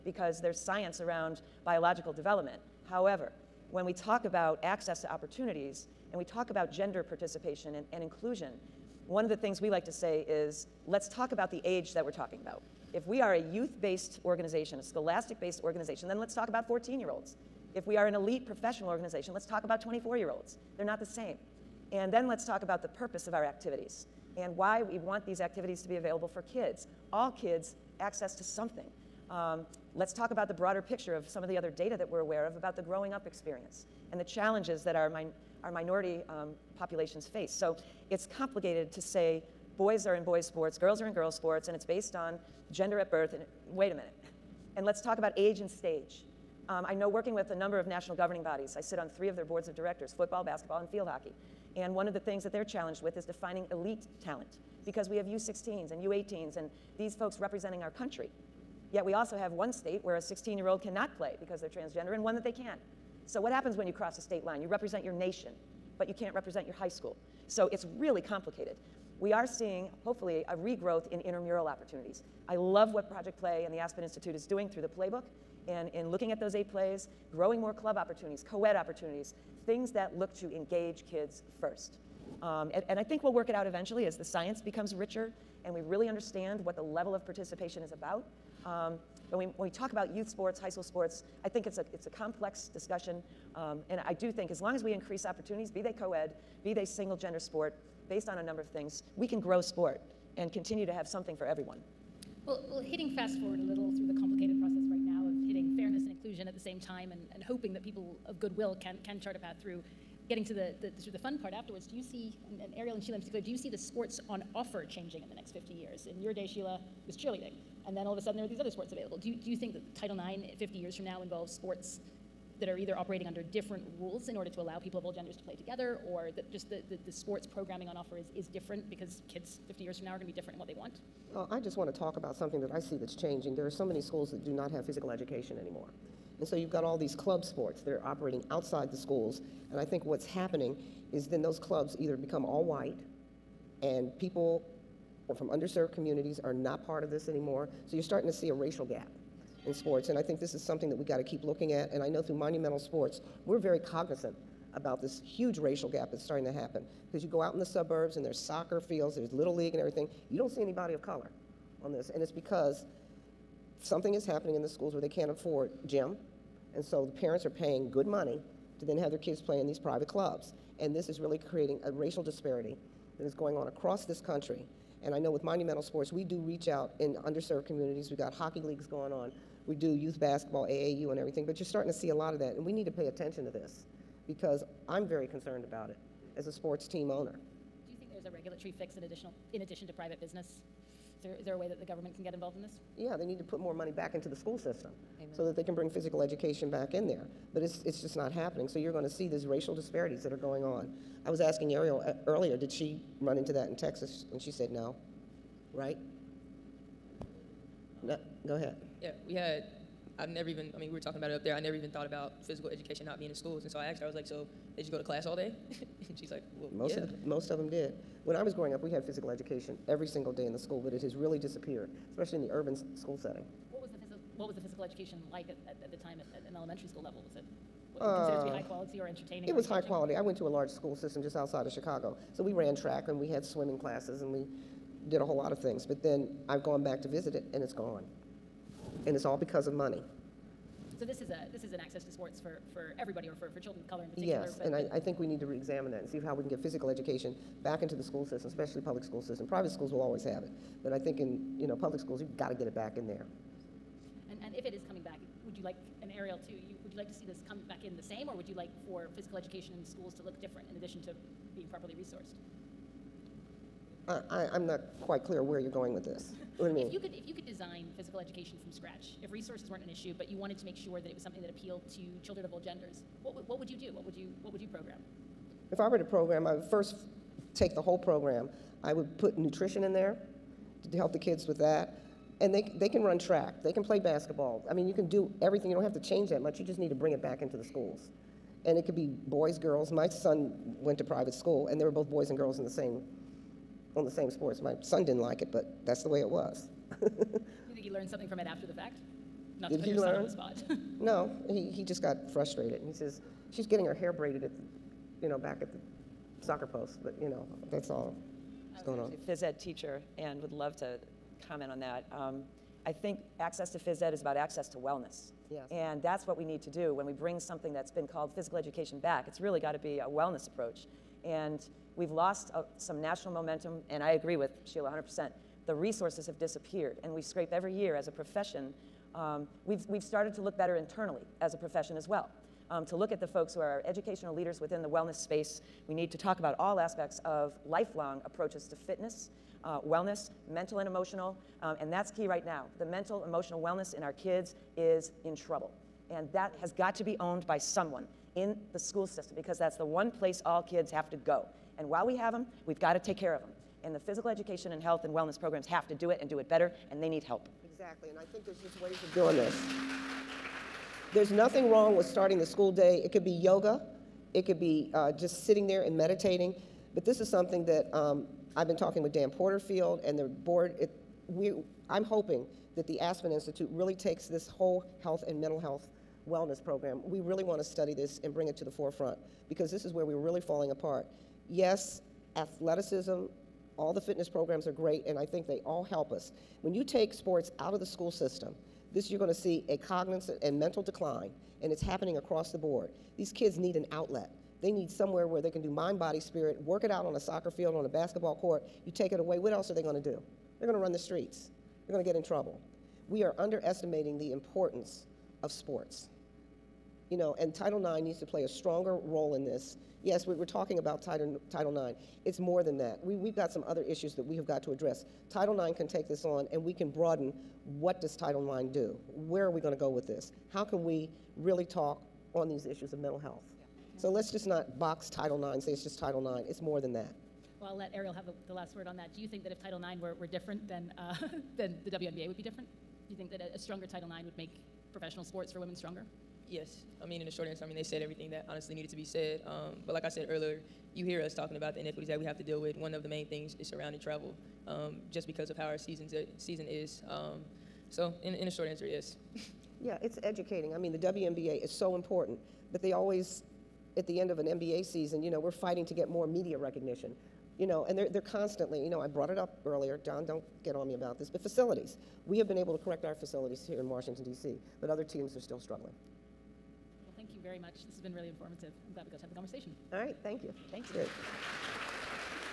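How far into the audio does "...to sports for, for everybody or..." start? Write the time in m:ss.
4:02.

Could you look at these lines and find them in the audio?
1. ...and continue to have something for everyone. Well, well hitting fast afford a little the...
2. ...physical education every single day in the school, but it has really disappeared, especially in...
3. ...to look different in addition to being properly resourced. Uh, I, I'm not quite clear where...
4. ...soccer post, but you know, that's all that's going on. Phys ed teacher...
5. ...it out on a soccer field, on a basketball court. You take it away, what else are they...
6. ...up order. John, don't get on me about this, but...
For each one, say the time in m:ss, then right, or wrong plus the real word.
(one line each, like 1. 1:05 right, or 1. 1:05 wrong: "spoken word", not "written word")
1. 1:40 wrong: "forward", not "afford"
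2. 3:39 right
3. 4:20 right
4. 5:06 right
5. 6:36 right
6. 7:39 wrong: "earlier", not "order".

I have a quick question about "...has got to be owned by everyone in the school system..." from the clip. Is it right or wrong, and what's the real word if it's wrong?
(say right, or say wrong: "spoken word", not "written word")
wrong: "someone", not "everyone".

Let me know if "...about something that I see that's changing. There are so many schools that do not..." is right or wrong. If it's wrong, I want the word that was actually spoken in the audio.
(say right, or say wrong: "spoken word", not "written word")
right.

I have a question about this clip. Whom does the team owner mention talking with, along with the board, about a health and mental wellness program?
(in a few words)
Dan Porterfield.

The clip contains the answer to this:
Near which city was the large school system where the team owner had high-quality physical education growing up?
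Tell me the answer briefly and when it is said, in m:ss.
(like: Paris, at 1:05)
Chicago, at 3:51.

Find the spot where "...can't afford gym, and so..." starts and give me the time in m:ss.
2:45.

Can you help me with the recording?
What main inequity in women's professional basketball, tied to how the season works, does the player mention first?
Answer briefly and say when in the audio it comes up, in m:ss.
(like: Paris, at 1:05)
Travel, at 7:23.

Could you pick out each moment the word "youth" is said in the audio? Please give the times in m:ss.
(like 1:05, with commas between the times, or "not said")
0:13, 1:30, 2:59.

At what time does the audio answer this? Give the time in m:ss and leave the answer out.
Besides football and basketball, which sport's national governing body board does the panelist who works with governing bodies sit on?
0:50.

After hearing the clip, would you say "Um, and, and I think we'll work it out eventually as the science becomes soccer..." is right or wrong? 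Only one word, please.
wrong.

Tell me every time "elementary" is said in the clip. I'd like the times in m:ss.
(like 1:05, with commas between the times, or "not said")
3:46.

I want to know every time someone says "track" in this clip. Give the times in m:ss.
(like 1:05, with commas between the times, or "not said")
3:52, 4:43.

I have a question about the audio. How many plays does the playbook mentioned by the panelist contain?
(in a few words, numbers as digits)
8.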